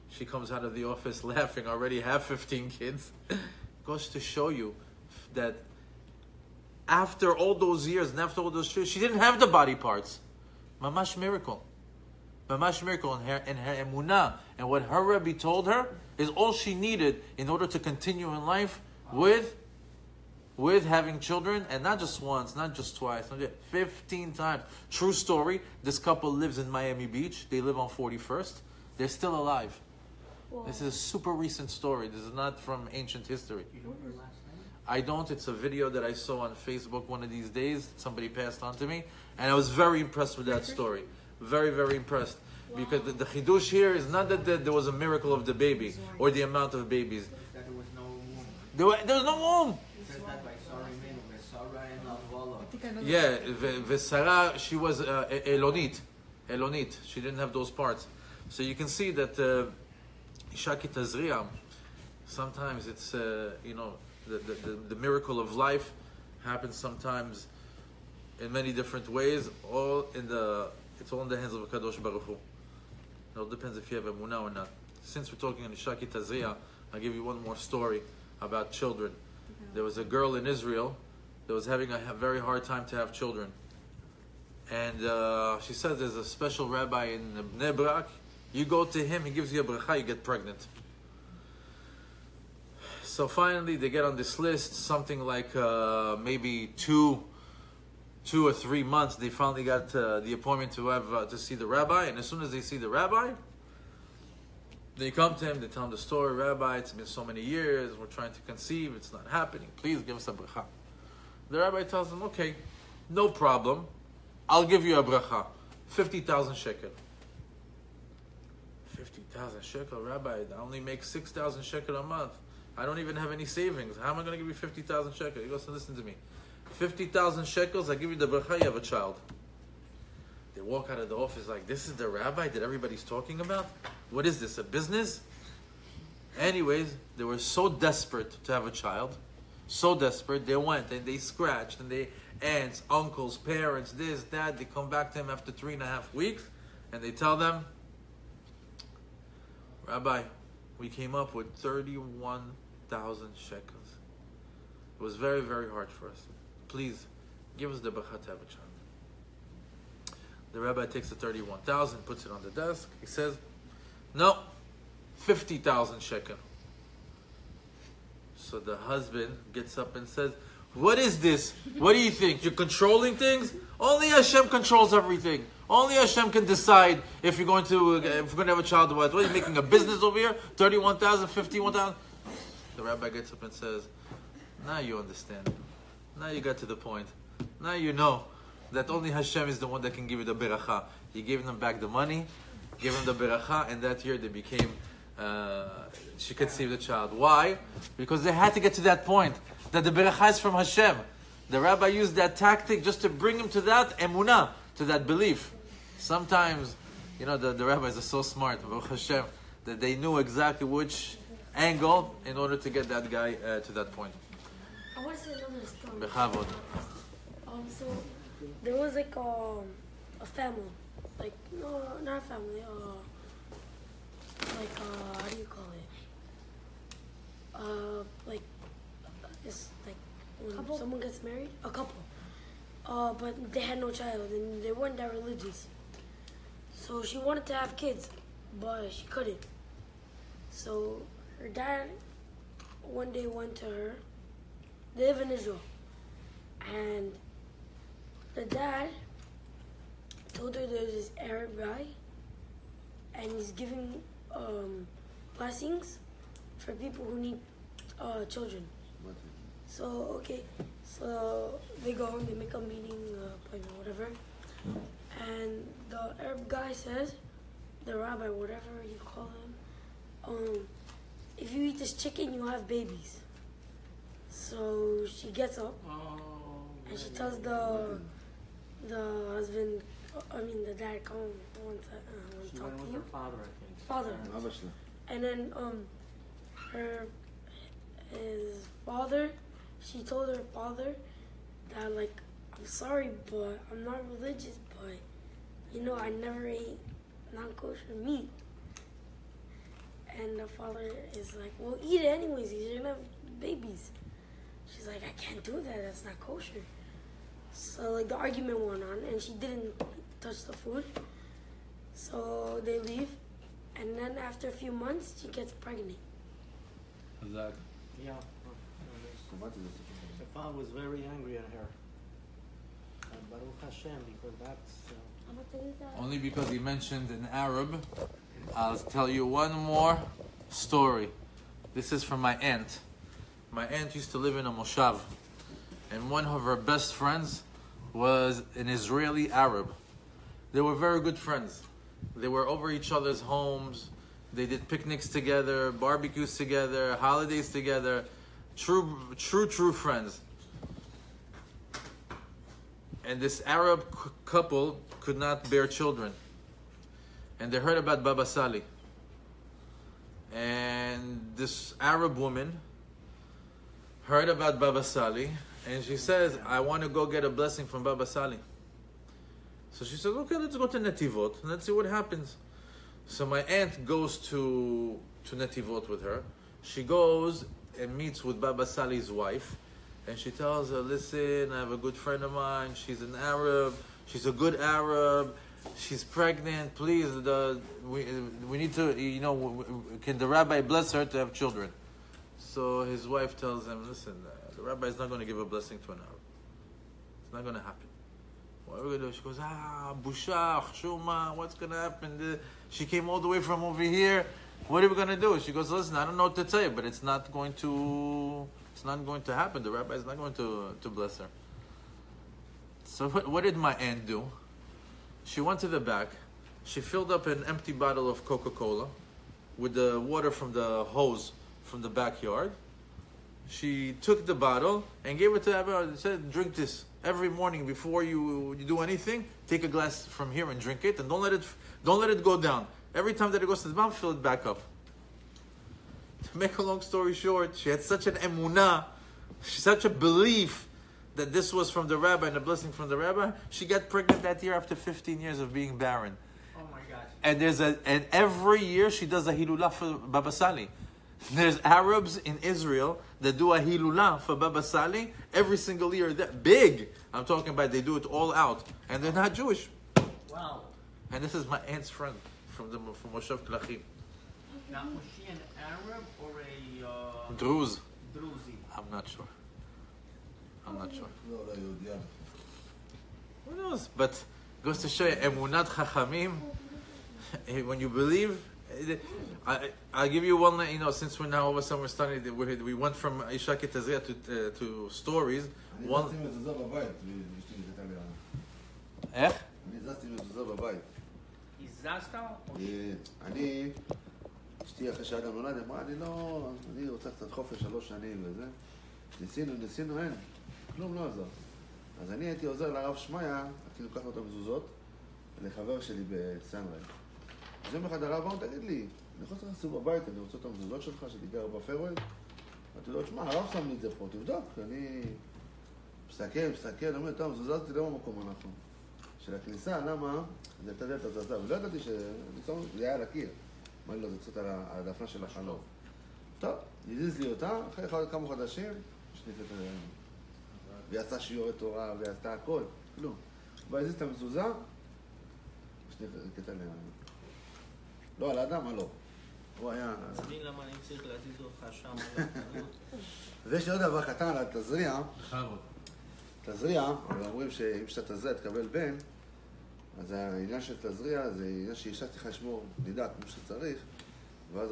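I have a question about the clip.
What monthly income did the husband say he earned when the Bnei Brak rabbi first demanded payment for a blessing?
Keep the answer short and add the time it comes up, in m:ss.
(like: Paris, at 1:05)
6,000 shekels, at 2:01.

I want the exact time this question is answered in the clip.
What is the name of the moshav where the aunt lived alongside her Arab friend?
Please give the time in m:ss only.
7:43.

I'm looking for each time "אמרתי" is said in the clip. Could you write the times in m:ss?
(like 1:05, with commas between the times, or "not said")
8:32, 8:43.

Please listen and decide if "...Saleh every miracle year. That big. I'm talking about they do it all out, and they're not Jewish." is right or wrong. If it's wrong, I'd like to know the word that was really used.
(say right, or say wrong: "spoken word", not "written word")
wrong: "single", not "miracle".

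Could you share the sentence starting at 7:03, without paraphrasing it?
She took the bottle and gave it to Abba and said, Drink this every morning before you, you do anything.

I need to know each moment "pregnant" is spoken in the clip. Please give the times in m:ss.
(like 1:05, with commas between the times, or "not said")
1:30, 5:15, 6:26, 7:23.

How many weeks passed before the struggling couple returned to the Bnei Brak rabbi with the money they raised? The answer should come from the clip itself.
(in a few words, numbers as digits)
3.5 weeks.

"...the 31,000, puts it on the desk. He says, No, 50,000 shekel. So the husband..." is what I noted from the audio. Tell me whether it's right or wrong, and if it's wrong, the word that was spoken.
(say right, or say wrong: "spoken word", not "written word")
right.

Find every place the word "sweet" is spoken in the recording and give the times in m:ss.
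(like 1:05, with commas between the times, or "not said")
not said.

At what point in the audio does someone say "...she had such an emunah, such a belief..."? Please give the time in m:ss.
7:17.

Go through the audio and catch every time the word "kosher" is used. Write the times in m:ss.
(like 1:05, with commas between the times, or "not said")
4:57, 5:06.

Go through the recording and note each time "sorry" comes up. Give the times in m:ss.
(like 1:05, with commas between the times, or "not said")
4:52.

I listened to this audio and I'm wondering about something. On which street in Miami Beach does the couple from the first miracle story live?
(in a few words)
41st.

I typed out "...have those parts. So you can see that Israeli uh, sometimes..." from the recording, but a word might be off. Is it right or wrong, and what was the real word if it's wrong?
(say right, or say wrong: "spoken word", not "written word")
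wrong: "Ishaki", not "Israeli".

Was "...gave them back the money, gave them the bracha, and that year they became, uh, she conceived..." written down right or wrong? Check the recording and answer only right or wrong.
wrong.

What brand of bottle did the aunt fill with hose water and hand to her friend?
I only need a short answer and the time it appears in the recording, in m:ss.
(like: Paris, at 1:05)
Coca-Cola, at 6:58.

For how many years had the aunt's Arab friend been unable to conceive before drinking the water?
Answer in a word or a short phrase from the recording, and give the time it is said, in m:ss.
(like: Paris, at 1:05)
15, at 7:24.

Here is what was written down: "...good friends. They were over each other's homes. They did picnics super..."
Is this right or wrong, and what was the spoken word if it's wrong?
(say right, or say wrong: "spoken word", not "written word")
wrong: "together", not "super".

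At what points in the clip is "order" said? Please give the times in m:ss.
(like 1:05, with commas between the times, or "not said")
0:17, 3:32.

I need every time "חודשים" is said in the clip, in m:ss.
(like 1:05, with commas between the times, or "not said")
8:48.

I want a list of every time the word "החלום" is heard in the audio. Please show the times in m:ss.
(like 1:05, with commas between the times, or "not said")
8:45.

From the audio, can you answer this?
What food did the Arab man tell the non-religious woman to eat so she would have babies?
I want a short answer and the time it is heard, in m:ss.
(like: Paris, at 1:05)
Chicken, at 4:31.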